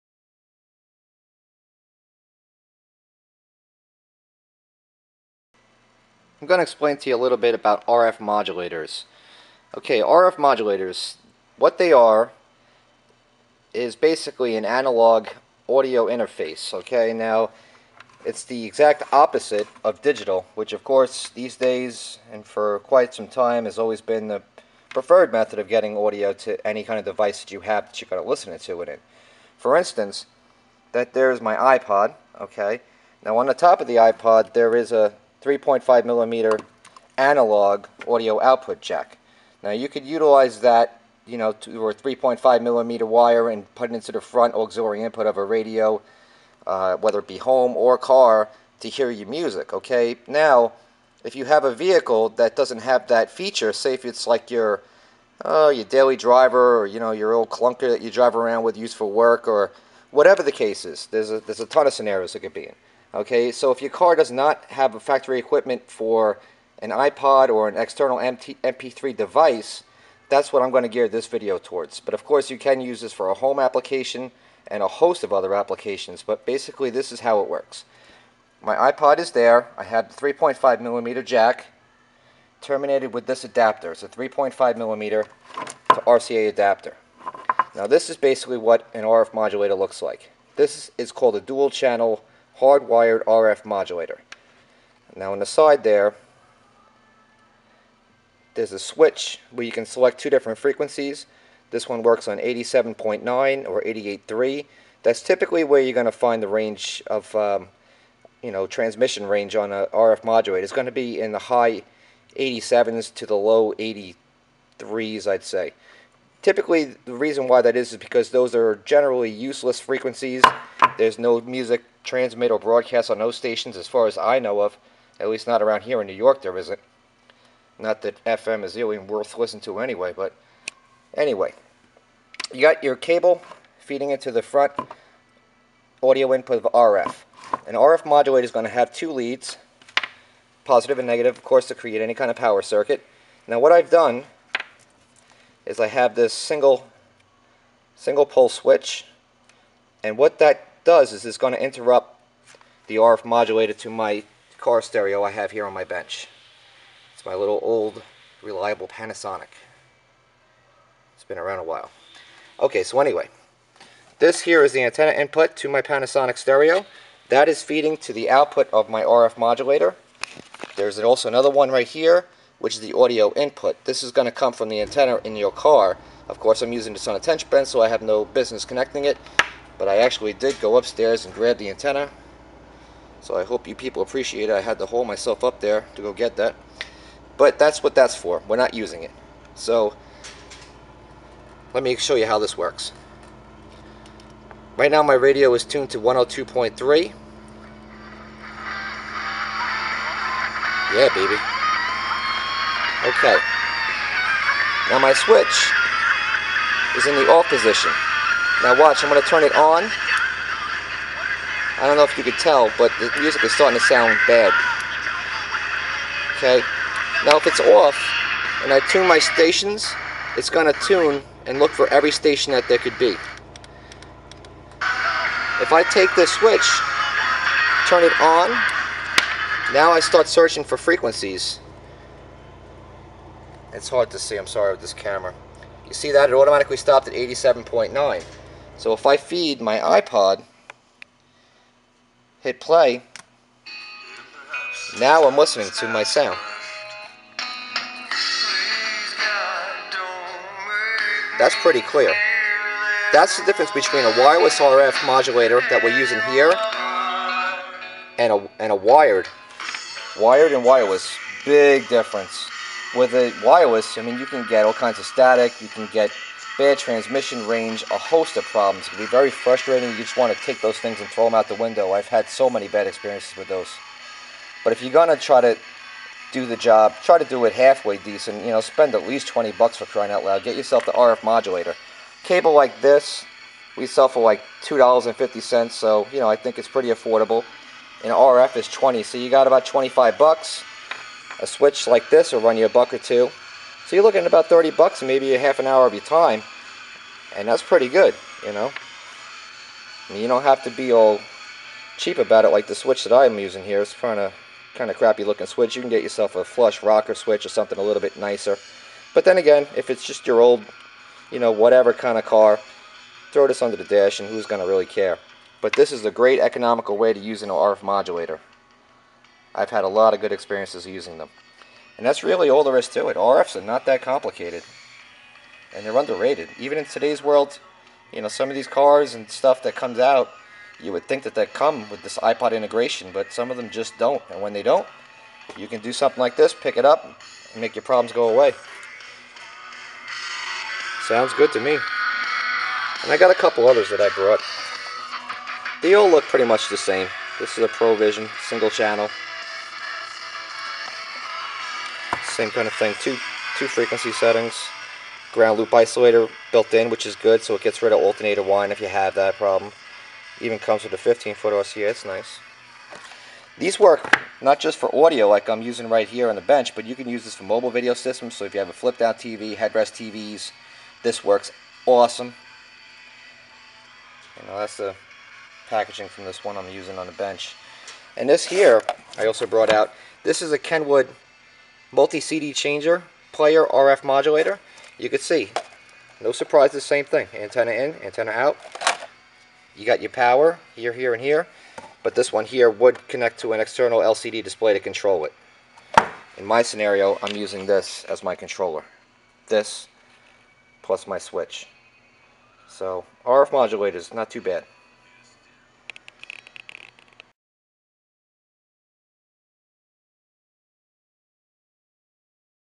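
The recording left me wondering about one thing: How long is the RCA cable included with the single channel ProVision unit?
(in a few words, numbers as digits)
15 feet.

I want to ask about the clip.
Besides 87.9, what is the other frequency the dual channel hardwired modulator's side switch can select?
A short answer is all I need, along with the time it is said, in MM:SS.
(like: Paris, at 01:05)
88.3, at 01:43.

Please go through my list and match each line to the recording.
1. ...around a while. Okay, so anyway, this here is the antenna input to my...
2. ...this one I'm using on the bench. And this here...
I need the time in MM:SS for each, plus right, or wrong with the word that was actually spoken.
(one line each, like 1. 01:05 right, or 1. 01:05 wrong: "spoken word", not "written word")
1. 02:41 right
2. 06:16 right.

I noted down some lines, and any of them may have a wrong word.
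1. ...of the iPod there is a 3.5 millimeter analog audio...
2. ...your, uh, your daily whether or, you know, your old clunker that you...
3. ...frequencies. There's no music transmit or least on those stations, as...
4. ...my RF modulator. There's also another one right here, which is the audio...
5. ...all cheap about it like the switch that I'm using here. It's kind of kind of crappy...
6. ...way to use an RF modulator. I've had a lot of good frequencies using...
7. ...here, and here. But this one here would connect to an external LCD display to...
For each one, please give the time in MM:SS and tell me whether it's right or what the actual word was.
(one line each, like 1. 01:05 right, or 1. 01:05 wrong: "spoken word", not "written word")
1. 00:33 right
2. 00:54 wrong: "driver", not "whether"
3. 01:59 wrong: "broadcast", not "least"
4. 02:48 right
5. 05:00 right
6. 05:16 wrong: "experiences", not "frequencies"
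7. 06:30 right.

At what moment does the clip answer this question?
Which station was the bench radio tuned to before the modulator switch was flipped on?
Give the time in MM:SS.
03:15.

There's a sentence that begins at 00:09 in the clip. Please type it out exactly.
Okay, RF modulators, what they are is basically an analog audio interface.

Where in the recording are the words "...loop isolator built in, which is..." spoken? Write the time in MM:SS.
05:55.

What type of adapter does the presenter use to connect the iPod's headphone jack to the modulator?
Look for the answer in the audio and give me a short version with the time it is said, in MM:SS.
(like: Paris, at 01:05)
3.5 millimeter to RCA, at 01:24.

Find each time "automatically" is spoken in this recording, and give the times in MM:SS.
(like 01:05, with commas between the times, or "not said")
03:56.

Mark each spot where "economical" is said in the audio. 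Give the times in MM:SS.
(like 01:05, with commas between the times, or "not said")
05:16.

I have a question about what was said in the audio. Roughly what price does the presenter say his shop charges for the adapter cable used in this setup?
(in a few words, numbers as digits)
$2.50.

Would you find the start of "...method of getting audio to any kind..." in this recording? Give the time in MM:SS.
00:25.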